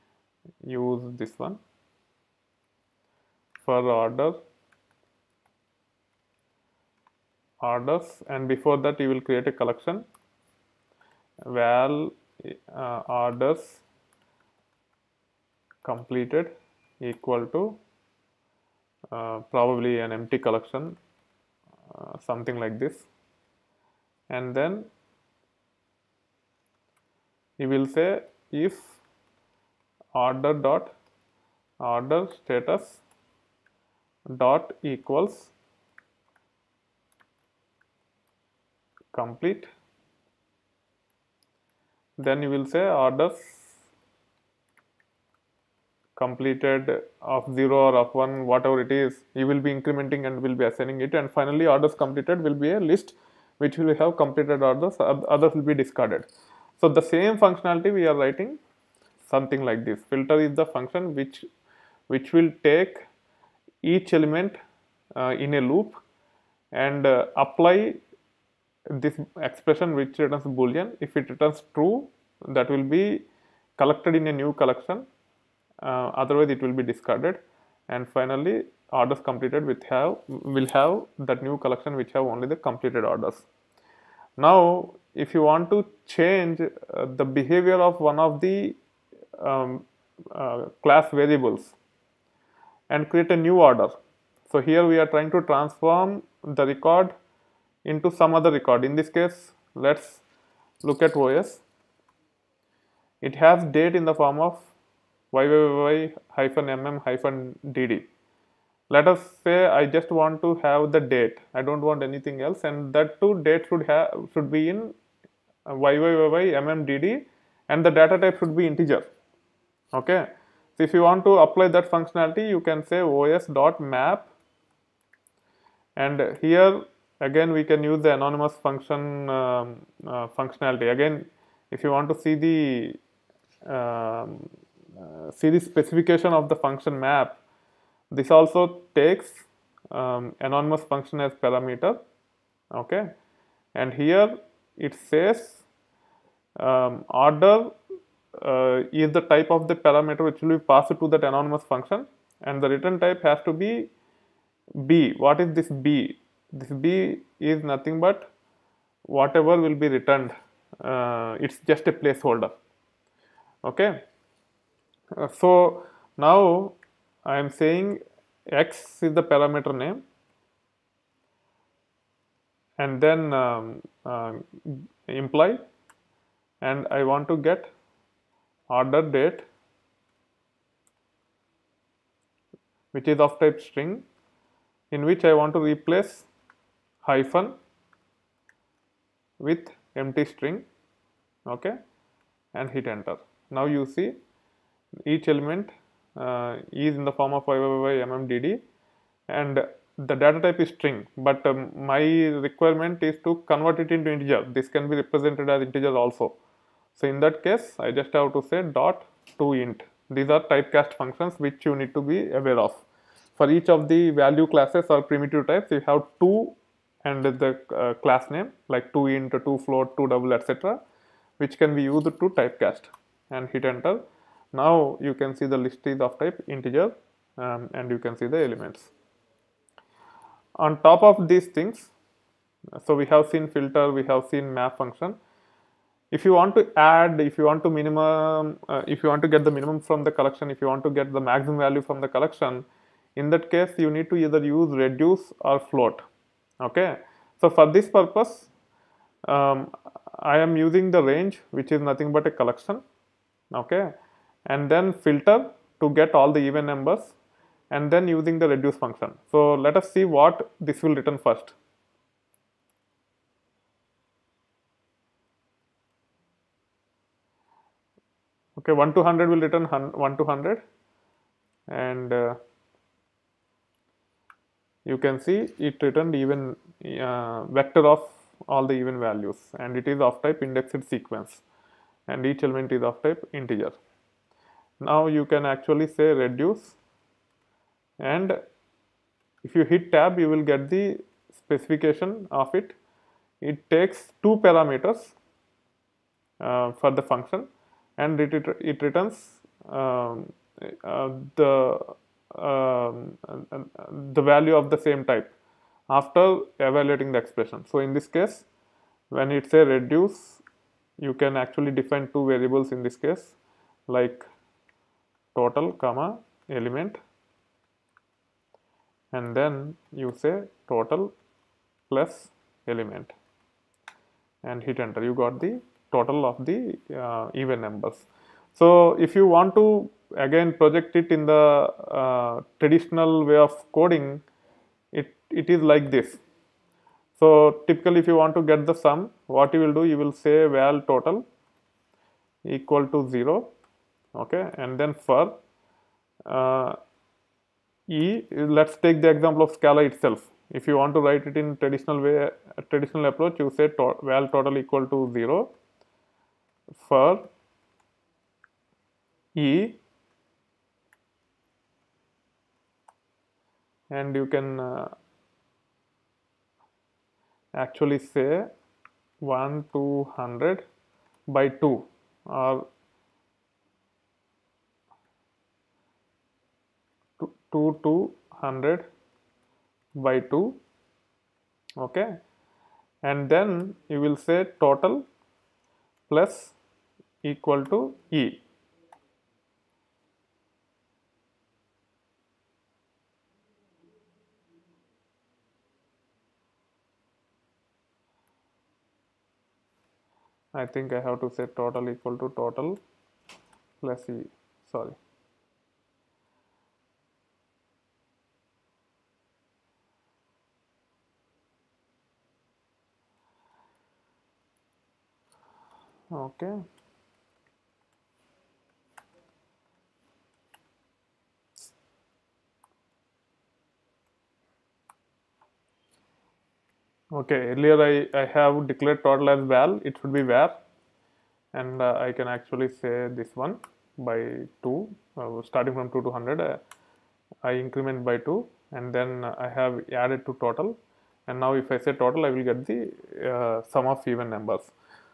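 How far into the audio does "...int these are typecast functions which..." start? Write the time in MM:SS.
03:29.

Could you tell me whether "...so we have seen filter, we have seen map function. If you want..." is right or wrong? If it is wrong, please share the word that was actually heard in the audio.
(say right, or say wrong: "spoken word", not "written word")
right.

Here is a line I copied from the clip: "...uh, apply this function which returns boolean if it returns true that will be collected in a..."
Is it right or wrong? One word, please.
wrong.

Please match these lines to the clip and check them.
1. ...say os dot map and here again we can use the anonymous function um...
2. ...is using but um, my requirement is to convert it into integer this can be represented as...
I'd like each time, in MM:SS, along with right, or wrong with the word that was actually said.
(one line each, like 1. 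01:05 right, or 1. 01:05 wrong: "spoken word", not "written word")
1. 02:02 right
2. 03:20 wrong: "string", not "using".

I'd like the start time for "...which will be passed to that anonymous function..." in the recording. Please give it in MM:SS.
02:30.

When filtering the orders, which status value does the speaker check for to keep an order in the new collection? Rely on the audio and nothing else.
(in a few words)
complete.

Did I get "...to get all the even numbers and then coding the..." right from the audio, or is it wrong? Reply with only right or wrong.
wrong.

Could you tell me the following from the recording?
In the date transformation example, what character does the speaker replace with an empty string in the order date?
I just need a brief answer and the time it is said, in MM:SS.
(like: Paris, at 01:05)
hyphen, at 03:07.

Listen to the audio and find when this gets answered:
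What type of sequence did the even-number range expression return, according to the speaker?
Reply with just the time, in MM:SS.
04:40.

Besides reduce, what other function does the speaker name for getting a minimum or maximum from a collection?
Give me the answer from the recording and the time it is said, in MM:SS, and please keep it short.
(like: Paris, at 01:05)
fold, at 04:05.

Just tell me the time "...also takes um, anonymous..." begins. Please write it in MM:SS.
02:18.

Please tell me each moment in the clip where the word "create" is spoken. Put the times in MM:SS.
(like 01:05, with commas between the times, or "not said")
00:09, 01:33.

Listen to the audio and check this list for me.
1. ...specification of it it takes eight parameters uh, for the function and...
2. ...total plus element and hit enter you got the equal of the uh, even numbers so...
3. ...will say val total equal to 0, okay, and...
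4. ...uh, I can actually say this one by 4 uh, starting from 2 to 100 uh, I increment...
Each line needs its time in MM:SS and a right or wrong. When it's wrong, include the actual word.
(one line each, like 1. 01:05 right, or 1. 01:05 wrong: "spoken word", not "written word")
1. 04:51 wrong: "two", not "eight"
2. 05:20 wrong: "total", not "equal"
3. 05:39 right
4. 07:11 wrong: "2", not "4".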